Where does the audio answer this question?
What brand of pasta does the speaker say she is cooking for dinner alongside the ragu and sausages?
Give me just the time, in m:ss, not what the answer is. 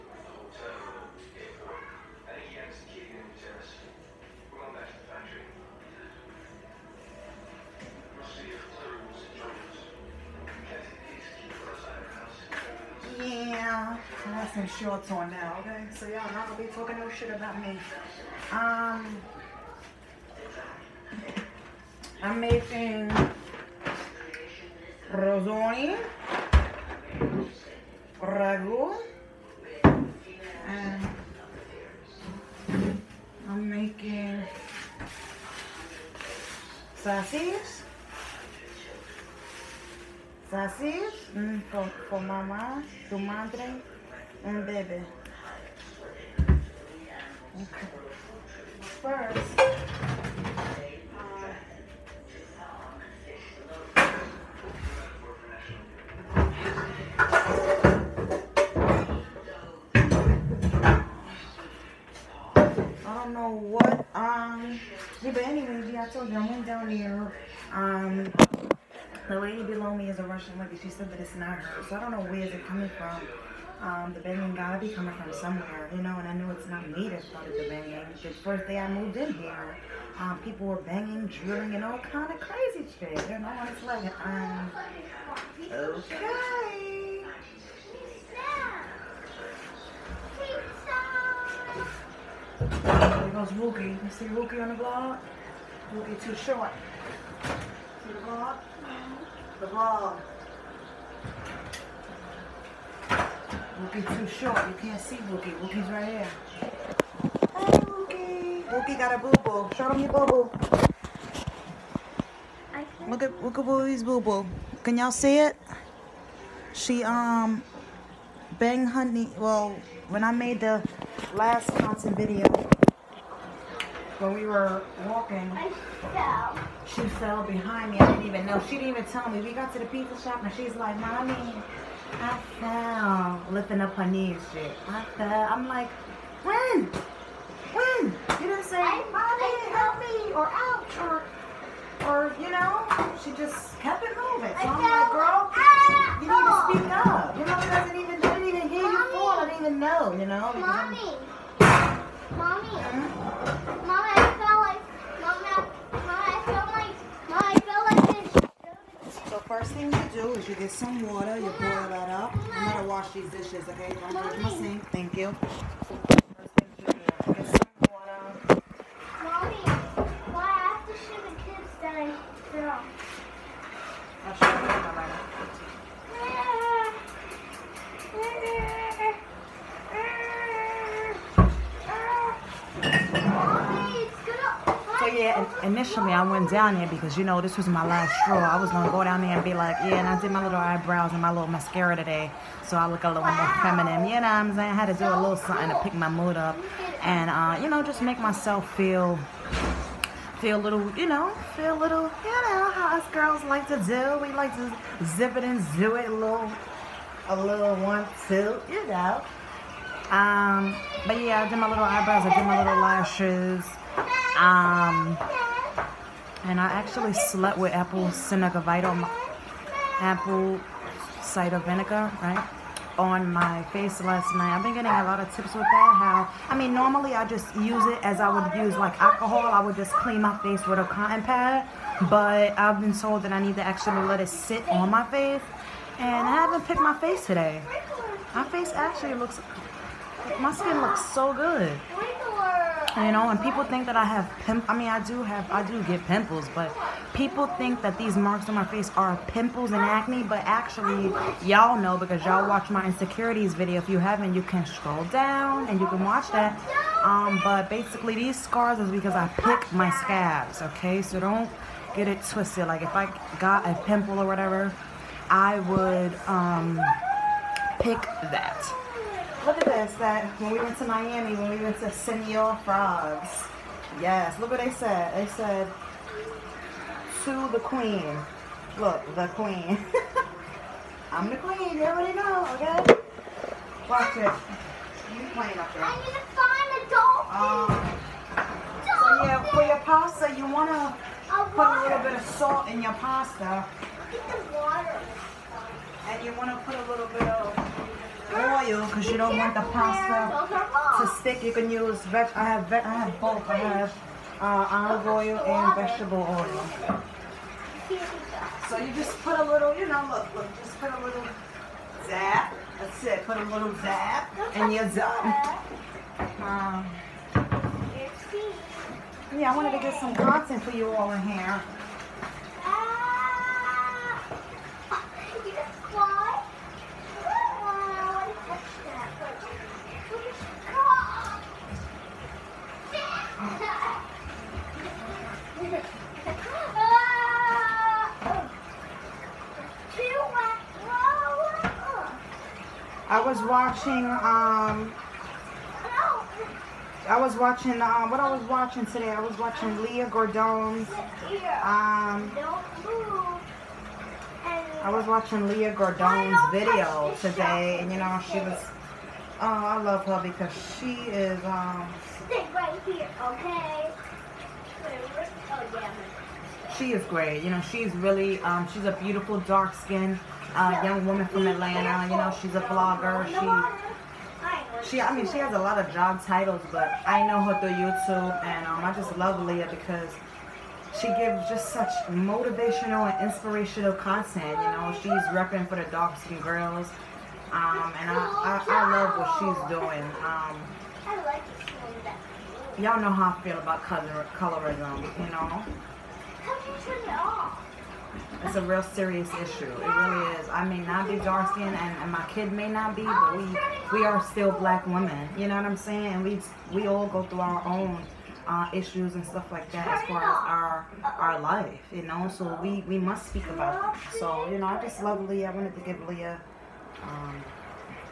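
0:25.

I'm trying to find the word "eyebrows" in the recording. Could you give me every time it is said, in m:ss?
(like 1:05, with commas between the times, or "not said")
3:10, 3:31.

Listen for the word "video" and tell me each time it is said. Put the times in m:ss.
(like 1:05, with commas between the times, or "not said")
2:02, 4:13, 5:56.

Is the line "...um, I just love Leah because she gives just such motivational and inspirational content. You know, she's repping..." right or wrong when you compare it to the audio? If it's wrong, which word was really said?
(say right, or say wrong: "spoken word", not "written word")
right.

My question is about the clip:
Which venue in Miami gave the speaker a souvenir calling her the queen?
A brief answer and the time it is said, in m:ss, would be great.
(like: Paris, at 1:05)
Senor Frogs, at 4:31.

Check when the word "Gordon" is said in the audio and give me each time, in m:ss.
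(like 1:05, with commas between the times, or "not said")
5:50, 5:55.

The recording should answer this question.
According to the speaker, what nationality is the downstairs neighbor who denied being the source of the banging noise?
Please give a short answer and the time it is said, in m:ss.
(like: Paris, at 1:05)
Russian, at 1:10.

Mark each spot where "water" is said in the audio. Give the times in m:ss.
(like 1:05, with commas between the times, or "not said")
2:41, 4:54.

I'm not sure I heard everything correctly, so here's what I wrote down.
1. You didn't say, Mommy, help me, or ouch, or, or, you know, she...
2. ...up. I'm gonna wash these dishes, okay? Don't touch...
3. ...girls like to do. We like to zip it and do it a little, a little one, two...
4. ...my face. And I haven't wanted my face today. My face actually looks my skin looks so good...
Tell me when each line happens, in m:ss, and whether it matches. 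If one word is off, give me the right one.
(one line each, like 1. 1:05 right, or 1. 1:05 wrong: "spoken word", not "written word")
1. 2:18 right
2. 2:42 right
3. 3:23 right
4. 3:54 wrong: "picked", not "wanted".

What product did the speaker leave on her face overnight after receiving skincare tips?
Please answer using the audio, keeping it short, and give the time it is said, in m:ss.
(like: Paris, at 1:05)
Apple cider vinegar, at 3:40.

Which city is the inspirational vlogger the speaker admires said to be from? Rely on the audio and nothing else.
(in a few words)
Atlanta.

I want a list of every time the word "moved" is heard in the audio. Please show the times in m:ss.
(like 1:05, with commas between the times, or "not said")
1:18.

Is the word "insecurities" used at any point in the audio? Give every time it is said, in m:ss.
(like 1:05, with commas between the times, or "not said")
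4:12.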